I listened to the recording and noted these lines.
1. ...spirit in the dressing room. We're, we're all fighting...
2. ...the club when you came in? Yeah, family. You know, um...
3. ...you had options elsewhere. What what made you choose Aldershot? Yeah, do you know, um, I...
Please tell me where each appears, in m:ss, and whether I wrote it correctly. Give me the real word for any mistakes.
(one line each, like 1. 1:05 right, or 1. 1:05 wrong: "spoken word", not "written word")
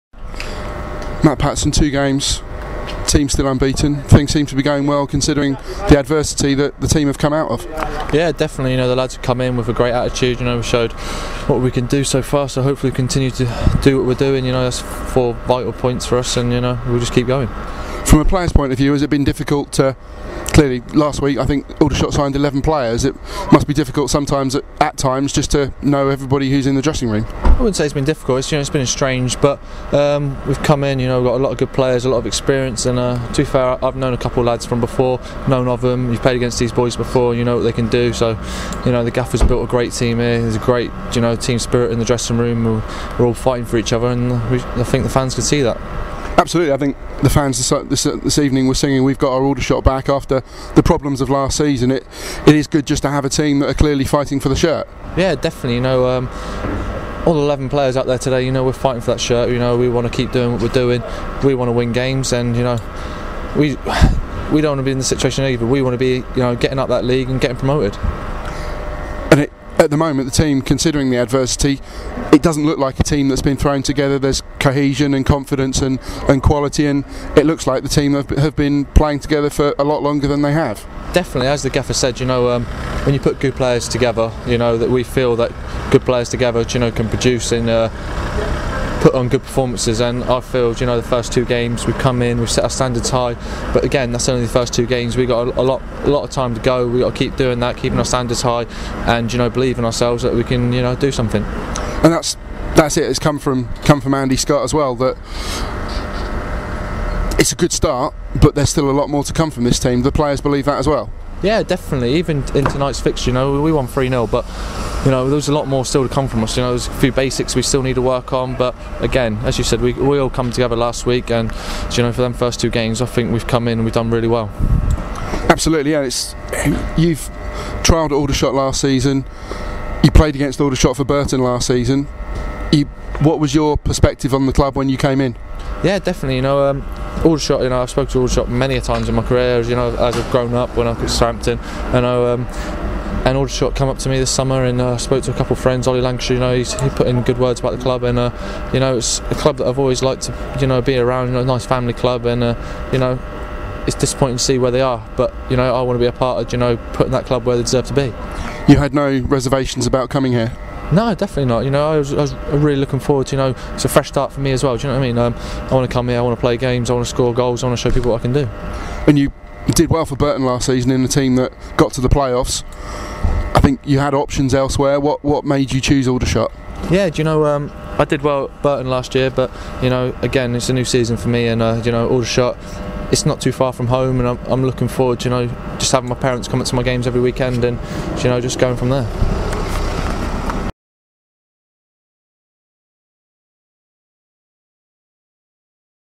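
1. 0:41 right
2. 2:14 wrong: "definitely", not "family"
3. 2:53 right.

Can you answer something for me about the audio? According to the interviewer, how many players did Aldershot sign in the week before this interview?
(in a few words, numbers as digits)
11.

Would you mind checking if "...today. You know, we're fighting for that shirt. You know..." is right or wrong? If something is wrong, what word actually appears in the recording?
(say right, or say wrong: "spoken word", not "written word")
right.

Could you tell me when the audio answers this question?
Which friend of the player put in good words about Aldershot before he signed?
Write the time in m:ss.
2:25.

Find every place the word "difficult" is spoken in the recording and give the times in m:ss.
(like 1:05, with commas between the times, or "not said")
0:19, 0:23, 0:28.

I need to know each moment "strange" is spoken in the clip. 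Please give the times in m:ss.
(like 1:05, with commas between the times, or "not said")
0:28.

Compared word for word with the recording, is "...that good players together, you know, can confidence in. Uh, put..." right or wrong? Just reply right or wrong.
wrong.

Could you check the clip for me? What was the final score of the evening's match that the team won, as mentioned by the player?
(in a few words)
3-0.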